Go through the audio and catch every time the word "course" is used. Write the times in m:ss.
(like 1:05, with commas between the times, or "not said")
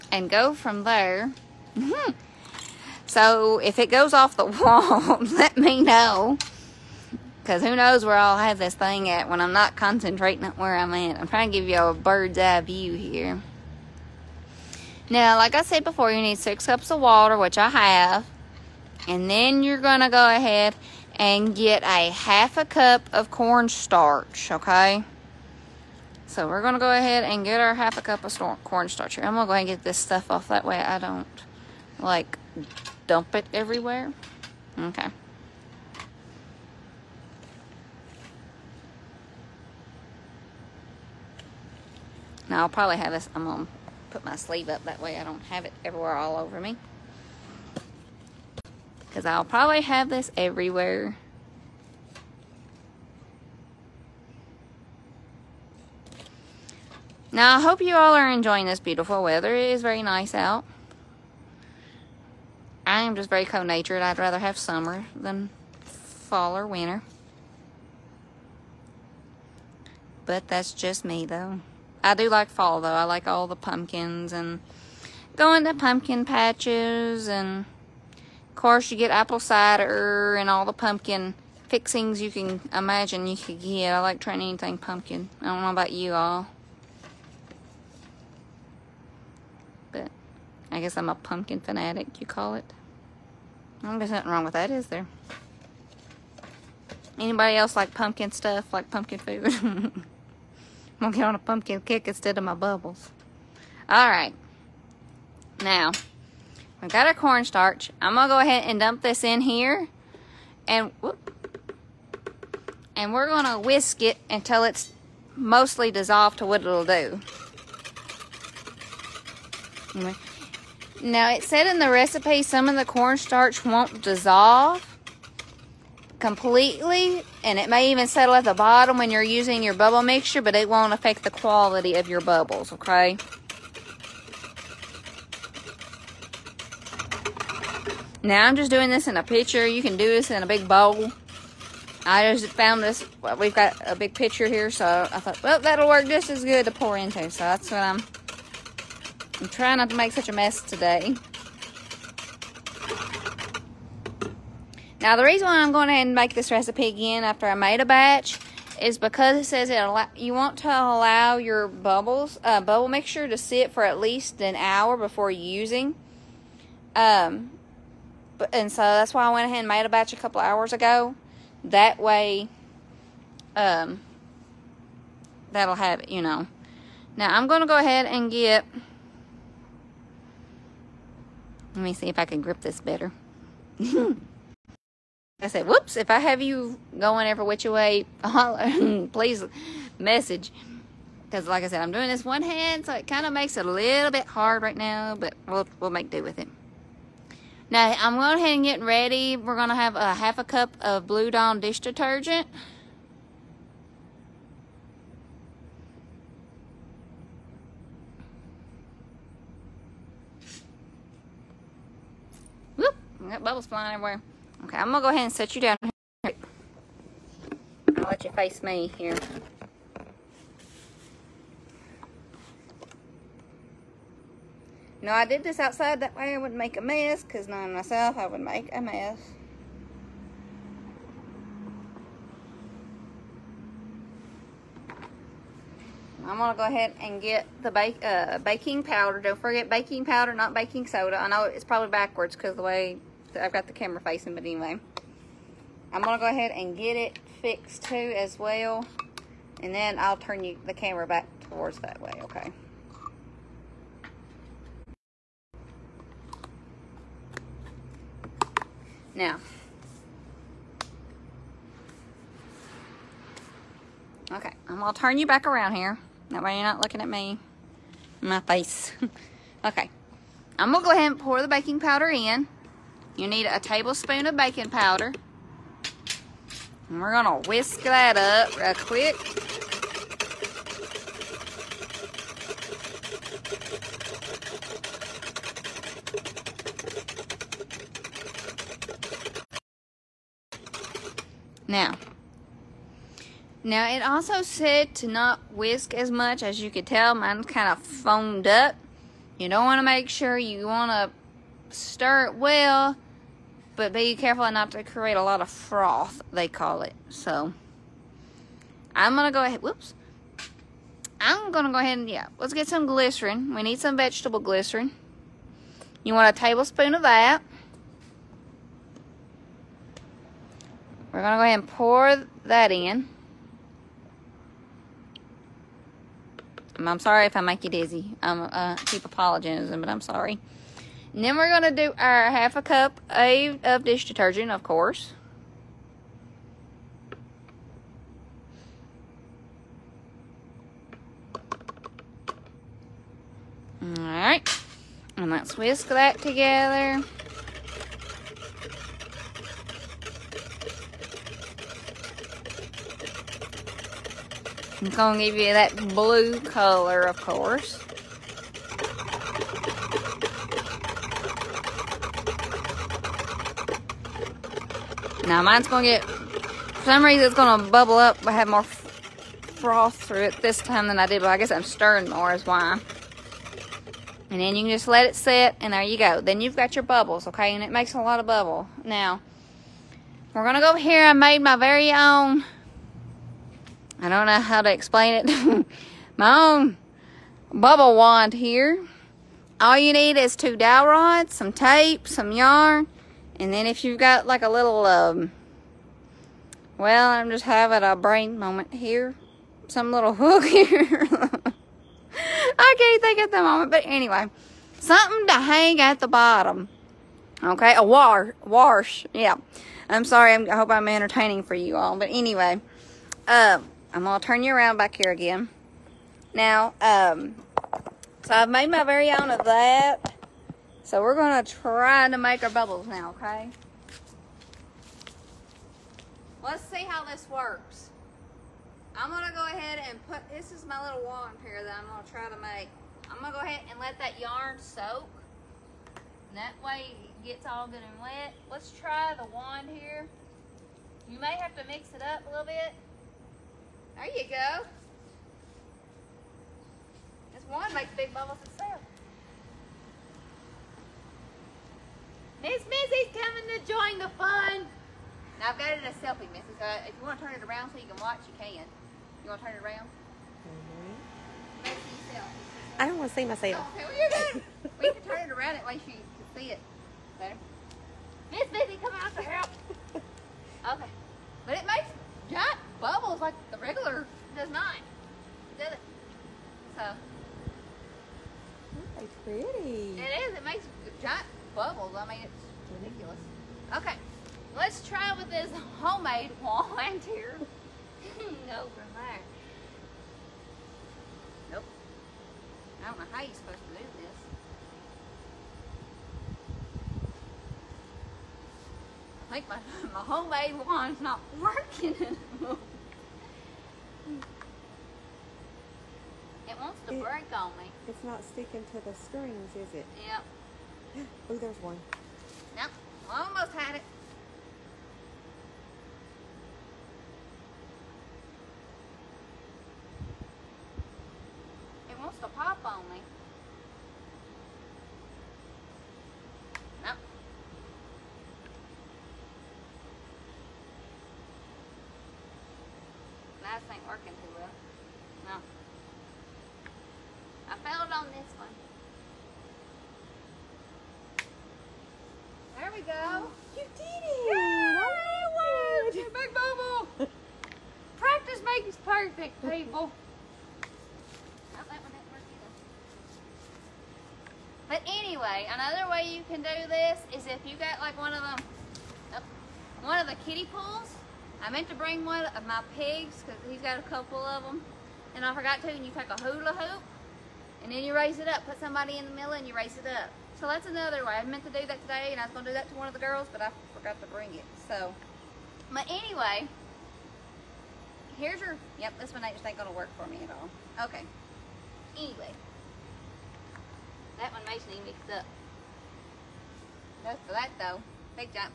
1:18, 5:34, 5:57.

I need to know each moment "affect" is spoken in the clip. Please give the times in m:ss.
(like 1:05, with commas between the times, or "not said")
2:10.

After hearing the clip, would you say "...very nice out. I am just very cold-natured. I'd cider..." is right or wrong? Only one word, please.
wrong.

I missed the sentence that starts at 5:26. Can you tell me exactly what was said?
I'm sorry if I make you dizzy.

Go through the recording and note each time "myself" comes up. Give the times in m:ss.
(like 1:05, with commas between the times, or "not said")
3:47, 7:43.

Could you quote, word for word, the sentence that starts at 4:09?
And then I'll turn you the camera back towards that way, okay?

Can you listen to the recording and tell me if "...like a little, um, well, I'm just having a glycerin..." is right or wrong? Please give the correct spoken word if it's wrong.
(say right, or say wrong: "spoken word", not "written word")
wrong: "brain", not "glycerin".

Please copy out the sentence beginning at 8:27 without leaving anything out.
It's not sticking to the strings, is it?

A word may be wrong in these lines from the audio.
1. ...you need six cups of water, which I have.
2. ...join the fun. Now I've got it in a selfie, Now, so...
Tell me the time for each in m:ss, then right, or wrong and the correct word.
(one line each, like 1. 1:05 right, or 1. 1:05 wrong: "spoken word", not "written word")
1. 0:16 right
2. 7:33 wrong: "Missy", not "Now".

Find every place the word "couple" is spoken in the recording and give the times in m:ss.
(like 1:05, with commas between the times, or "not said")
2:50, 9:23.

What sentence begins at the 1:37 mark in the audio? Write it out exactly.
Anybody else like pumpkin stuff, like pumpkin food?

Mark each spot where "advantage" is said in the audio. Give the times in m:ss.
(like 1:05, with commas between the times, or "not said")
not said.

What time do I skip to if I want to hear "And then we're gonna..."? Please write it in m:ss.
5:31.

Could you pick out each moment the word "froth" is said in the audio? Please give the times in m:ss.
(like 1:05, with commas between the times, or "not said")
5:05, 6:08.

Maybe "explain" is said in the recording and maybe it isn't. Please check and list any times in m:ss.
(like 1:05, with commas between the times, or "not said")
6:24.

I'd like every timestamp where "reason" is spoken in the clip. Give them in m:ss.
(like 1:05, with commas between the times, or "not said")
2:35, 6:07.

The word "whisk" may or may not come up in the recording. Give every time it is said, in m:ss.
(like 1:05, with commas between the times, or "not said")
1:53, 4:37, 4:55, 5:45.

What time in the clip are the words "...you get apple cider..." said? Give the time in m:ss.
1:18.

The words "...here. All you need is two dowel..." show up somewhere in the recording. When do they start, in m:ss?
6:28.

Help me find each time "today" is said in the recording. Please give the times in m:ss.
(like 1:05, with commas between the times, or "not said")
2:30, 9:31.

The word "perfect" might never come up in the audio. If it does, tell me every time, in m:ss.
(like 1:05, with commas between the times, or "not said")
9:08.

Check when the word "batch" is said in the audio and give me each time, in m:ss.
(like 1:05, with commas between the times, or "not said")
2:37, 2:49.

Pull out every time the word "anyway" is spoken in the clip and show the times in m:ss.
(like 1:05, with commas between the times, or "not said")
4:04, 6:43, 6:52, 9:14, 9:35, 9:41.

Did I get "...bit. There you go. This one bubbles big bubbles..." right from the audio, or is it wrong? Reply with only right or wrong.
wrong.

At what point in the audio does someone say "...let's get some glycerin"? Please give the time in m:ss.
5:12.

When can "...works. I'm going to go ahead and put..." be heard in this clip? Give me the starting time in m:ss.
7:07.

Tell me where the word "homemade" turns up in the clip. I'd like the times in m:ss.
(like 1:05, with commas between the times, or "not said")
8:05, 8:20.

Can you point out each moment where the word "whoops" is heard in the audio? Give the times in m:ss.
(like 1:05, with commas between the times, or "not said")
1:51, 3:05, 3:32, 5:09.